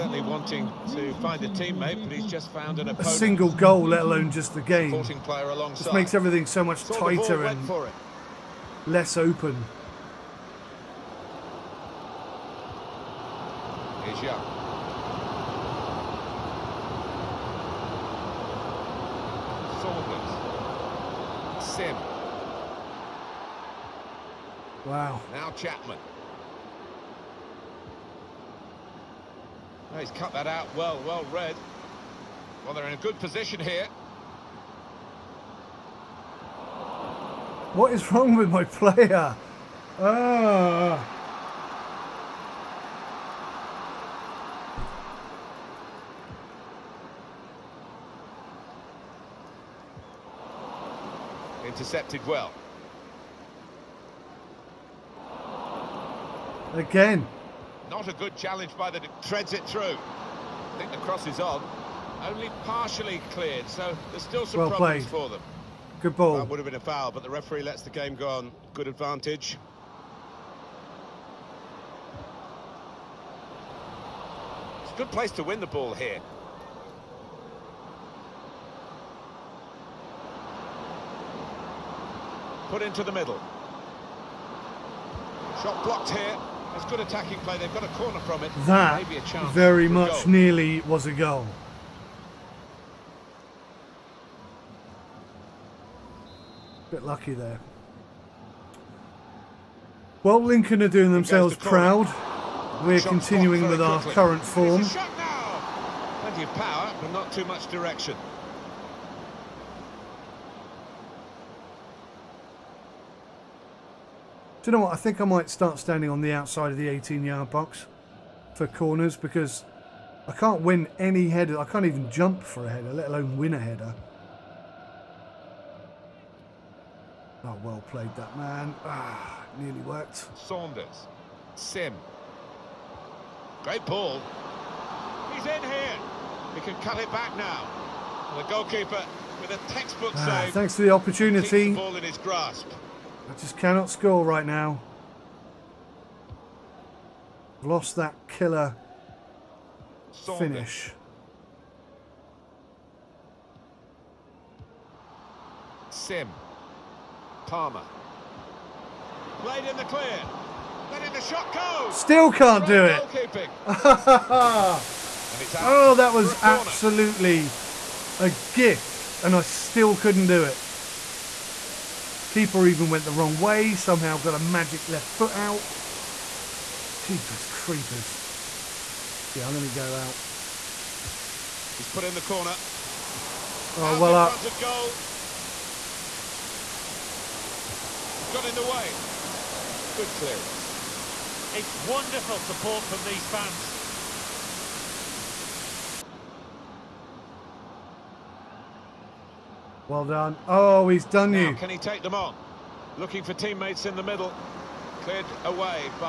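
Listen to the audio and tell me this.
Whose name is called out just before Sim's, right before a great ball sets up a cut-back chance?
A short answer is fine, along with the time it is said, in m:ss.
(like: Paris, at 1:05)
Saunders, at 2:10.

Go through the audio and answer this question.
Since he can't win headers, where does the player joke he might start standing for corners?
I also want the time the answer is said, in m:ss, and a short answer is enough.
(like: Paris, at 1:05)
Outside of the 18-yard box, at 1:56.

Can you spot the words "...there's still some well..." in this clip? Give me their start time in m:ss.
1:04.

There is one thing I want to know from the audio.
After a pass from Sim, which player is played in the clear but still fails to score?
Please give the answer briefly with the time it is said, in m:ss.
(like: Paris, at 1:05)
Palmer, at 2:37.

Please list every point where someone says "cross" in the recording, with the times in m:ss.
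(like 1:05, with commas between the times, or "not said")
1:00.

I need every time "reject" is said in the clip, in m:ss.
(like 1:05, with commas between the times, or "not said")
not said.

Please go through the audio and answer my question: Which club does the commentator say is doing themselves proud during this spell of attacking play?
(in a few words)
Lincoln.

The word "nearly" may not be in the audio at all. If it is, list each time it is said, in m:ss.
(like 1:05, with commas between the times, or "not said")
1:30, 2:09.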